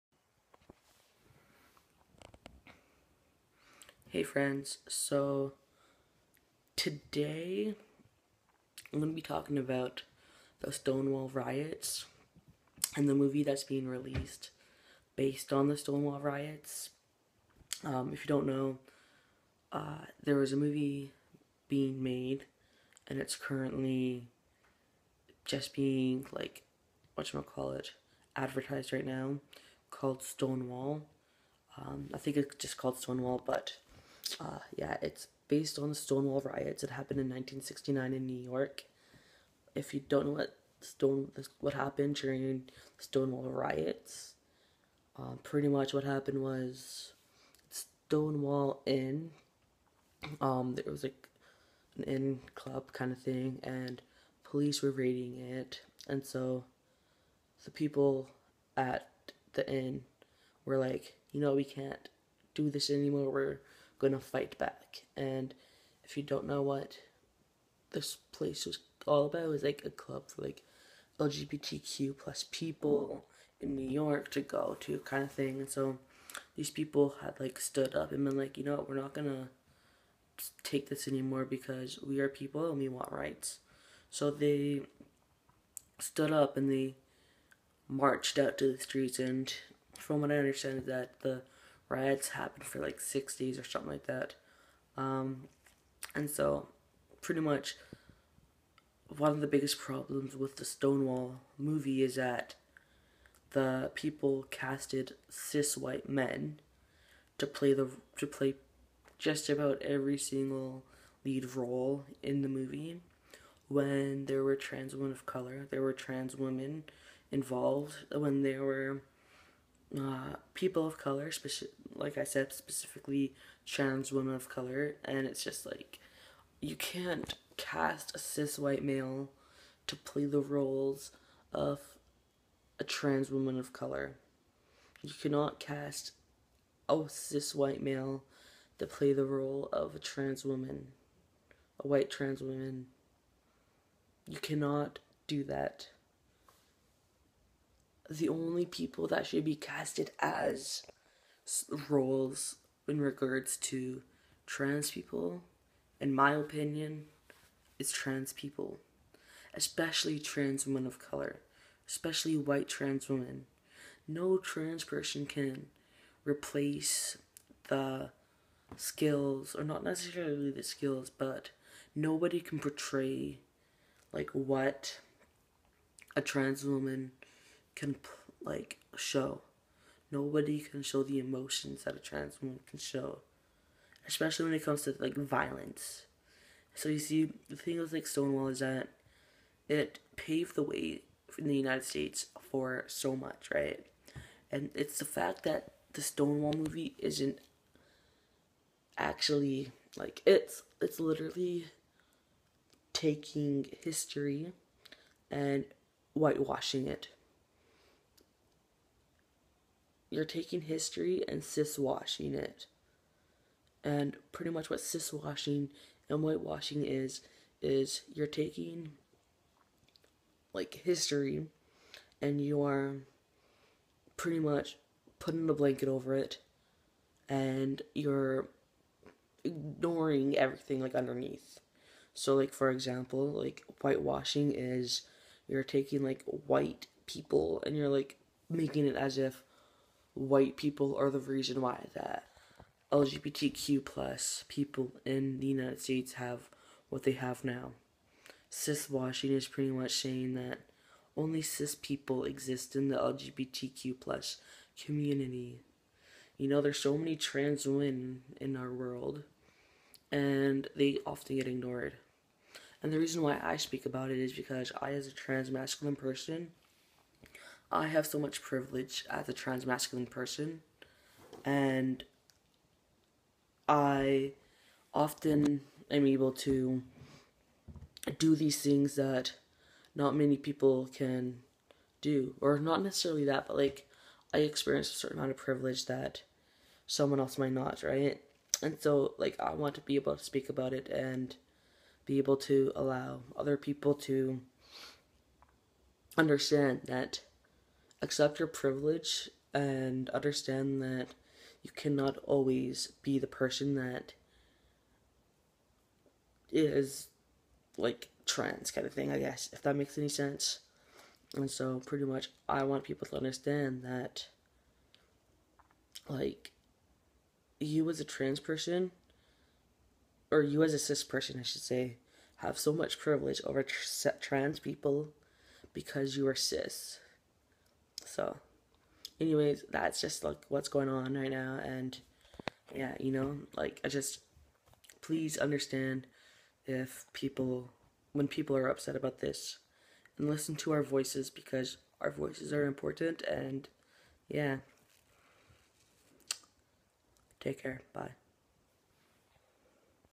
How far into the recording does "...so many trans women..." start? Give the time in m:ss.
4:16.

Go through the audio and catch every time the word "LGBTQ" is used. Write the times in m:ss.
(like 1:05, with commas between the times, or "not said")
1:11, 4:02, 4:12.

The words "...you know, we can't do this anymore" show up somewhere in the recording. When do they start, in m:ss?
1:01.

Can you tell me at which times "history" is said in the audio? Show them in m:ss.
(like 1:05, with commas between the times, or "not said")
3:23, 3:30, 3:40.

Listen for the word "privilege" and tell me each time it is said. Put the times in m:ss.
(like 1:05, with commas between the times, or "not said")
4:28, 4:45, 4:58, 5:22.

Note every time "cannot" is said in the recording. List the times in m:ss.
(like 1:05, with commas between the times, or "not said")
2:15, 2:24, 5:01.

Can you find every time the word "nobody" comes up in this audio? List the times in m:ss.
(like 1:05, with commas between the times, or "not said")
2:51, 3:00.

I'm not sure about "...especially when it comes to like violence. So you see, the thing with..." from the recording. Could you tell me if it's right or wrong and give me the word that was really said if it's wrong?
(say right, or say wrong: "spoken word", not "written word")
right.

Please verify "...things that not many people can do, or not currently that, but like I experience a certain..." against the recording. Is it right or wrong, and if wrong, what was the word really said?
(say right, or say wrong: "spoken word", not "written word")
wrong: "necessarily", not "currently".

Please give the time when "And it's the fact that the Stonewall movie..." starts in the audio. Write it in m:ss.
3:14.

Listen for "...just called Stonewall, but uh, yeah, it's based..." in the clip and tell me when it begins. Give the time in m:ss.
0:32.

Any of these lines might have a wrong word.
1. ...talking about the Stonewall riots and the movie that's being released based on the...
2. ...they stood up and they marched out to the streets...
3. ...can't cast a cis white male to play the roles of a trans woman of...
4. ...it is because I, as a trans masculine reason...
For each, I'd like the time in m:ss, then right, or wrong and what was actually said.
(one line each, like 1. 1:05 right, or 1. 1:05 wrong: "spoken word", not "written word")
1. 0:09 right
2. 1:24 right
3. 2:06 right
4. 4:24 wrong: "person", not "reason".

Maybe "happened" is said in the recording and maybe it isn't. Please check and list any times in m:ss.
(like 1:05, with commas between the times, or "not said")
0:36, 0:41, 0:46, 1:32.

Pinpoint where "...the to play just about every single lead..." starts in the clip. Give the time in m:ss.
1:47.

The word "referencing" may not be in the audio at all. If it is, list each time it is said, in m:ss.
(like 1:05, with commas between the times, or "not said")
not said.